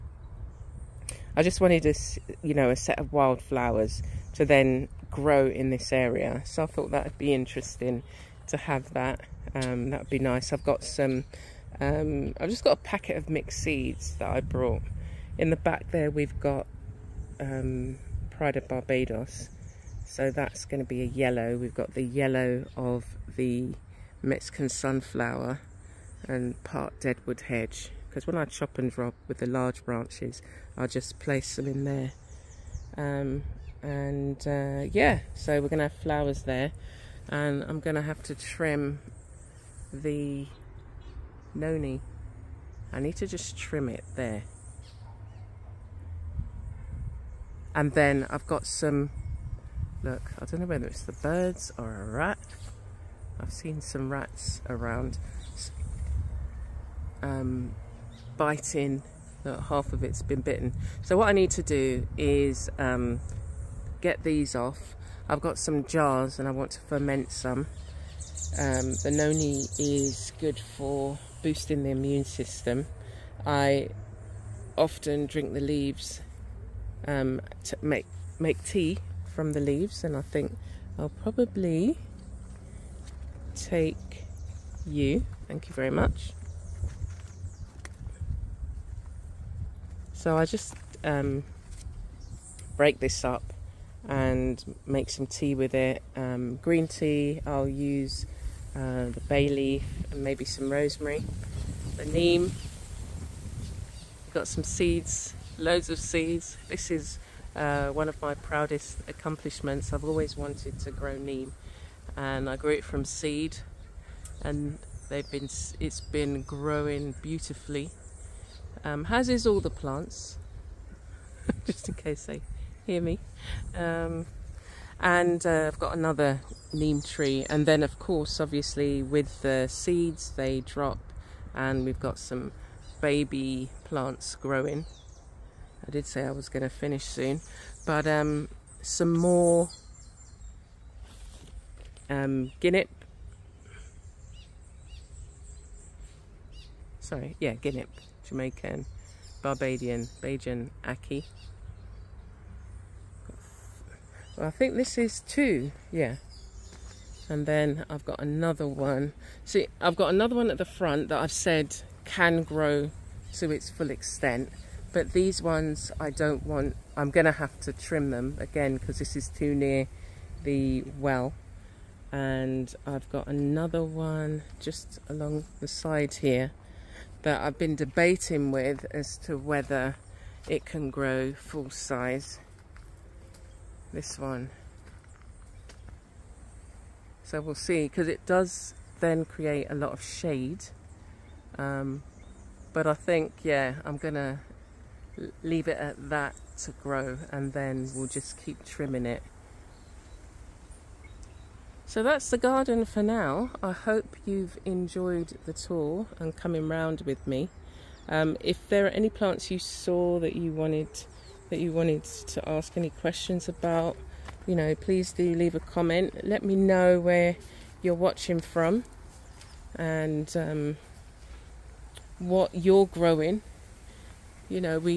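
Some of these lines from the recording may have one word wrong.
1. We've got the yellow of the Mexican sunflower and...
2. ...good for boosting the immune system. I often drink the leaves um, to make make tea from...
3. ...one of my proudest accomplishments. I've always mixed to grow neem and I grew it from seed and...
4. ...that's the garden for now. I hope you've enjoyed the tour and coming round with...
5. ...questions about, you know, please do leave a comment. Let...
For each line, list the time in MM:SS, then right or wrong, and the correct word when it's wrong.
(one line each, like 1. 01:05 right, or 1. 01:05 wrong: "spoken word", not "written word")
1. 00:21 right
2. 01:10 right
3. 01:47 wrong: "wanted", not "mixed"
4. 03:22 right
5. 03:32 right.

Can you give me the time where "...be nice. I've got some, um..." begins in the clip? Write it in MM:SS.
00:10.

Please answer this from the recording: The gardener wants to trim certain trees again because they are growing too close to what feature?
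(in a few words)
The well.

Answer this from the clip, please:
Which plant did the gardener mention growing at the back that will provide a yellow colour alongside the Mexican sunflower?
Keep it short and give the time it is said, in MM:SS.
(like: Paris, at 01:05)
Pride of Barbados, at 00:18.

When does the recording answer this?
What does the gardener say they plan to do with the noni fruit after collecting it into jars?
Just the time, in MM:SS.
01:06.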